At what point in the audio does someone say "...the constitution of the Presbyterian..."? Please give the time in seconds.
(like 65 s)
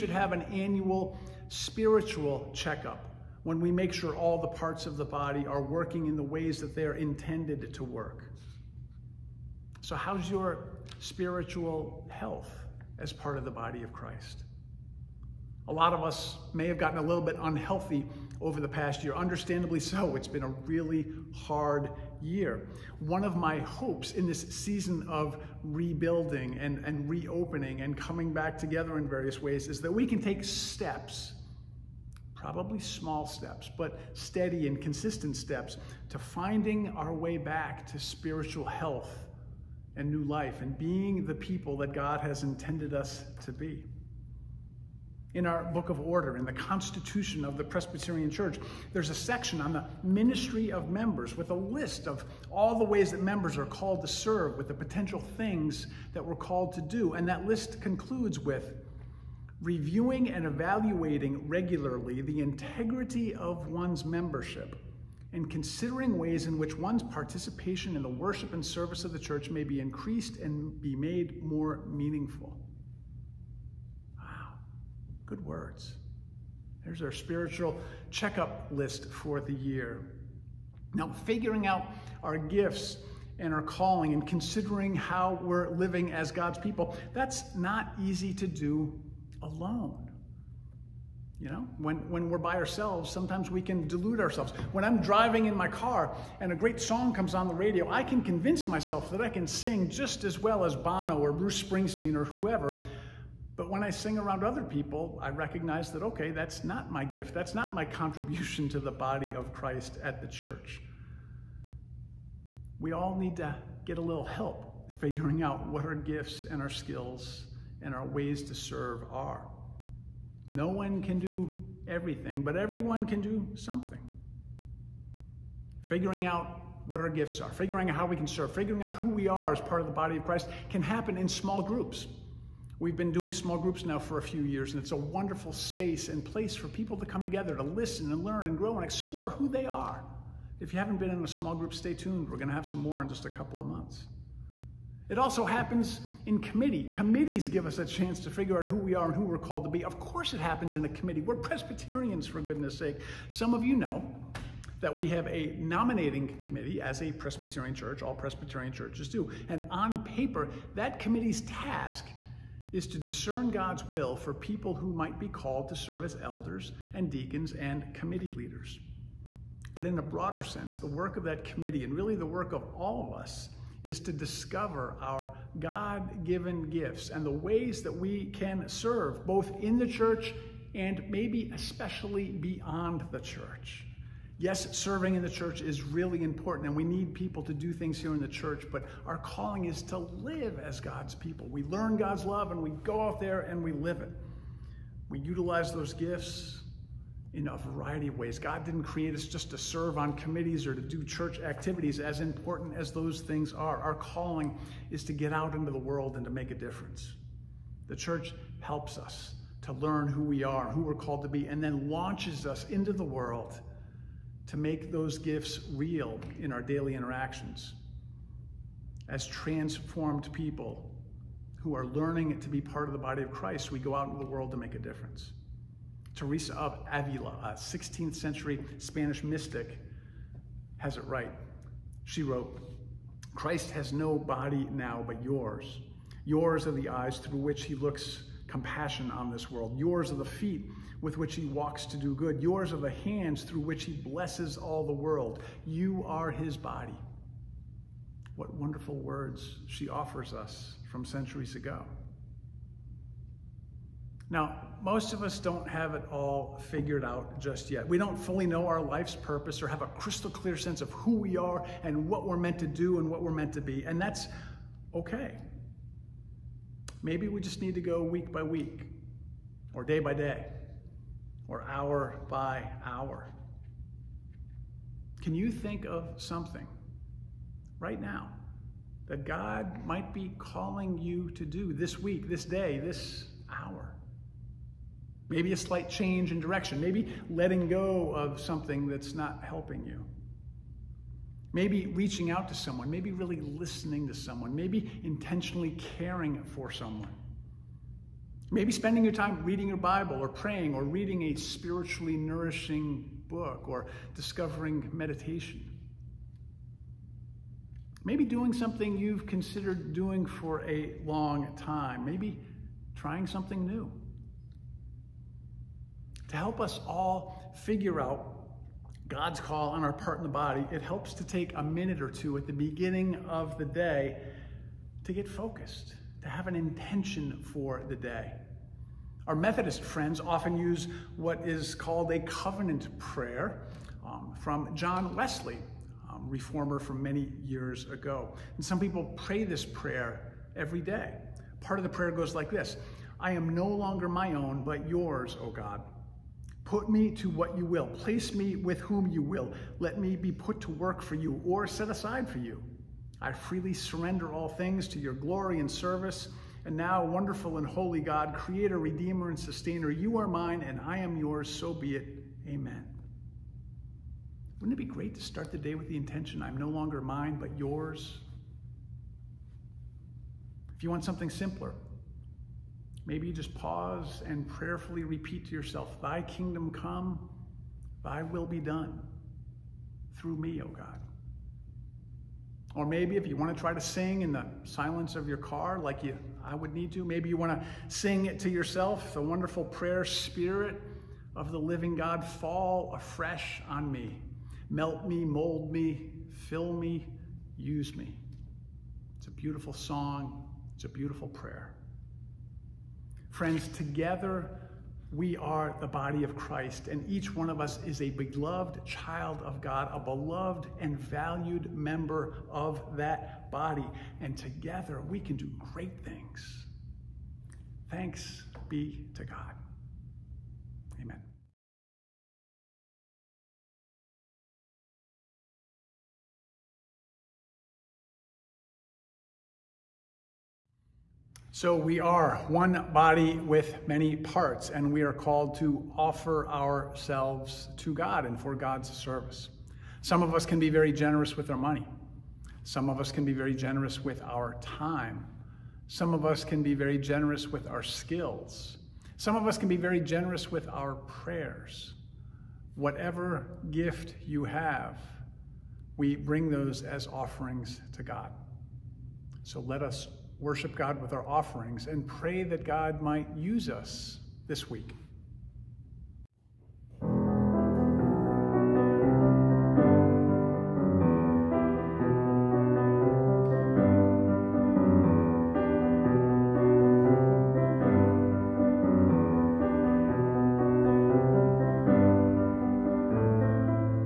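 46 s.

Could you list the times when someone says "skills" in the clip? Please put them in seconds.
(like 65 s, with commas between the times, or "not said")
116 s, 447 s.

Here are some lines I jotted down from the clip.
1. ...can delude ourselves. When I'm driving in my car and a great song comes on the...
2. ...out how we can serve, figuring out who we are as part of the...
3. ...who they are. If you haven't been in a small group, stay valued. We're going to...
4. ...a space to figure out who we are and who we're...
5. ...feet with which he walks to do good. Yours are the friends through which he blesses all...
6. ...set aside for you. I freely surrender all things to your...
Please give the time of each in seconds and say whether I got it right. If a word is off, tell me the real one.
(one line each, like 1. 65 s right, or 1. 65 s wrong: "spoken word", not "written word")
1. 93 s right
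2. 127 s right
3. 139 s wrong: "tuned", not "valued"
4. 147 s wrong: "chance", not "space"
5. 240 s wrong: "hands", not "friends"
6. 351 s right.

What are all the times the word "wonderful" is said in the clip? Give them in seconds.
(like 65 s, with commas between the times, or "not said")
134 s, 248 s, 357 s, 389 s.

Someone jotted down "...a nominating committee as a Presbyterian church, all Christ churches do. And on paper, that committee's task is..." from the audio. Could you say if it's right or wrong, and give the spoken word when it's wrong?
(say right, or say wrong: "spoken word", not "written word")
wrong: "Presbyterian", not "Christ".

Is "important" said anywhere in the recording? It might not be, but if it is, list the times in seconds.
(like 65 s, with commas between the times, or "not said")
186 s, 202 s.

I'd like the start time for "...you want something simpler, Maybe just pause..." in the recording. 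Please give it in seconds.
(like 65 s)
370 s.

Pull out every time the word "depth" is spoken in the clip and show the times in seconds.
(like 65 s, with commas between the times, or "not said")
not said.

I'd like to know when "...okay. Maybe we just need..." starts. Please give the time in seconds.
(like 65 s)
264 s.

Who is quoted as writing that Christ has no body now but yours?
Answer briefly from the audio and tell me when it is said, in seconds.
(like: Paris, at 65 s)
Teresa of Avila, at 226 s.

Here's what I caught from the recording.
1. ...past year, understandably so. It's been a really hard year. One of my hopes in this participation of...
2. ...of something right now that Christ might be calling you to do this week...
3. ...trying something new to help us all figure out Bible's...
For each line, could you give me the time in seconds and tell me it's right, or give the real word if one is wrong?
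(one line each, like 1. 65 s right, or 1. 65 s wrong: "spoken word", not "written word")
1. 18 s wrong: "season", not "participation"
2. 275 s wrong: "God", not "Christ"
3. 312 s wrong: "God", not "Bible".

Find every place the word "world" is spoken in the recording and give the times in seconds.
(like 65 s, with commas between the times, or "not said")
205 s, 213 s, 224 s, 239 s, 244 s.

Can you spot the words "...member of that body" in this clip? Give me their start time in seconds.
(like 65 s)
411 s.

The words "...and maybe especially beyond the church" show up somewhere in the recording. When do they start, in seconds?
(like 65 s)
180 s.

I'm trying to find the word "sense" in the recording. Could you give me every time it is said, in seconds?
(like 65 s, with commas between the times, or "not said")
170 s, 260 s.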